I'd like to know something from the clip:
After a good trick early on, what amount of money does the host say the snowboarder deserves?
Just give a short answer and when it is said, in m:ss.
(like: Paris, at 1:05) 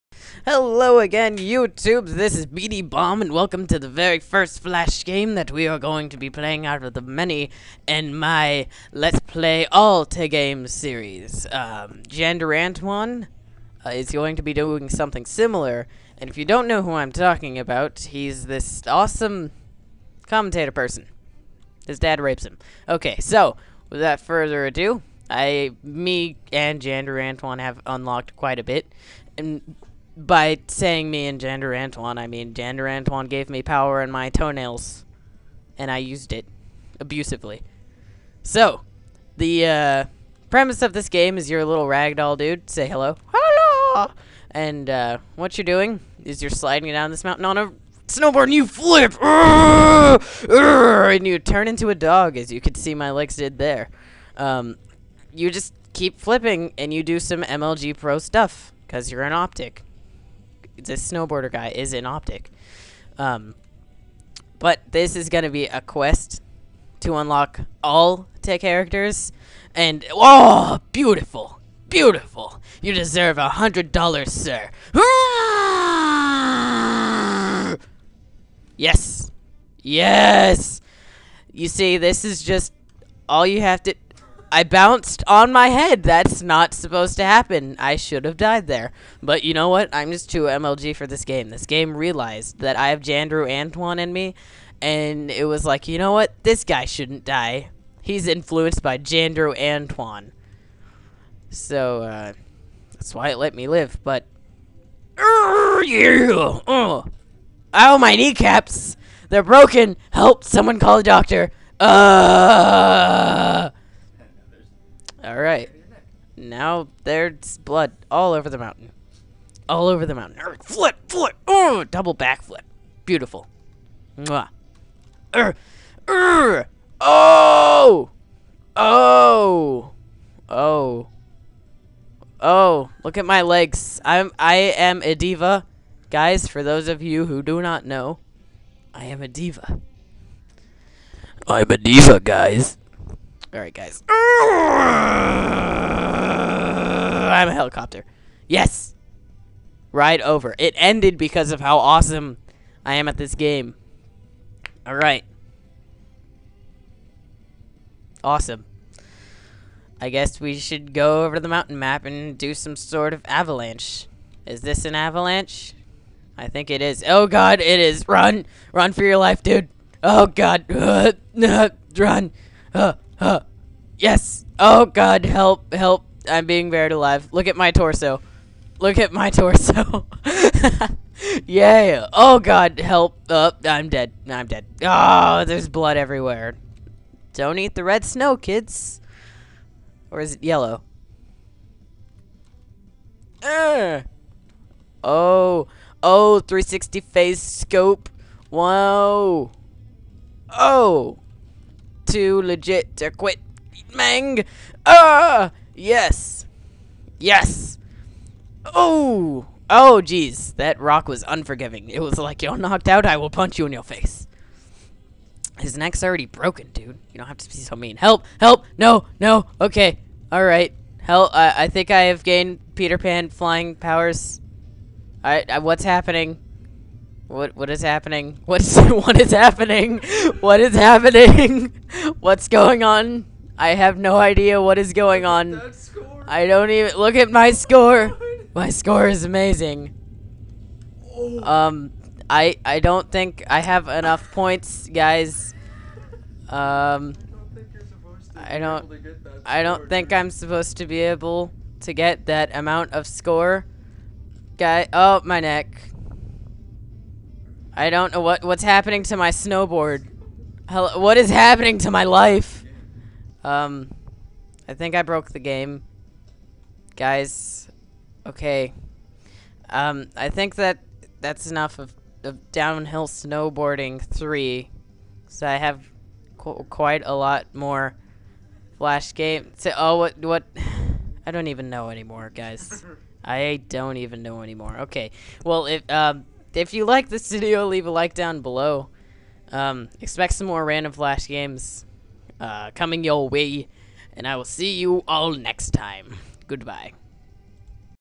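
$100, at 1:13.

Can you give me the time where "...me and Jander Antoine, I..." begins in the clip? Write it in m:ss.
0:31.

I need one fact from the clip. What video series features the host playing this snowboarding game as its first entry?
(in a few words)
Let's Play All Te Games.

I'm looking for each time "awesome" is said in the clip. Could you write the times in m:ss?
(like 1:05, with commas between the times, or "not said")
0:18, 2:31, 2:38.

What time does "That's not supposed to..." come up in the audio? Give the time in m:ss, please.
1:26.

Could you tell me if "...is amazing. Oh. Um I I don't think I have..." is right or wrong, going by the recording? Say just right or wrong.
right.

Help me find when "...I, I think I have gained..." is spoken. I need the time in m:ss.
3:41.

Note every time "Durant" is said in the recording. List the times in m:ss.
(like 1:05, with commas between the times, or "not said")
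0:27.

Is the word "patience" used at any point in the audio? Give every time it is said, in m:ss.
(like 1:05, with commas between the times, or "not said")
not said.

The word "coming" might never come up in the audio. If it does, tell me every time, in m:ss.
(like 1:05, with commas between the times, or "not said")
4:52.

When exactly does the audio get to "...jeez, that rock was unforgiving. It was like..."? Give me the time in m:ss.
3:30.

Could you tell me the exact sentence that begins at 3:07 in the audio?
Don't eat the red snow, kids.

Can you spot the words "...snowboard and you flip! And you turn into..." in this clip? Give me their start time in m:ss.
0:48.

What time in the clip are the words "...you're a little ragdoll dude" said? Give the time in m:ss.
0:41.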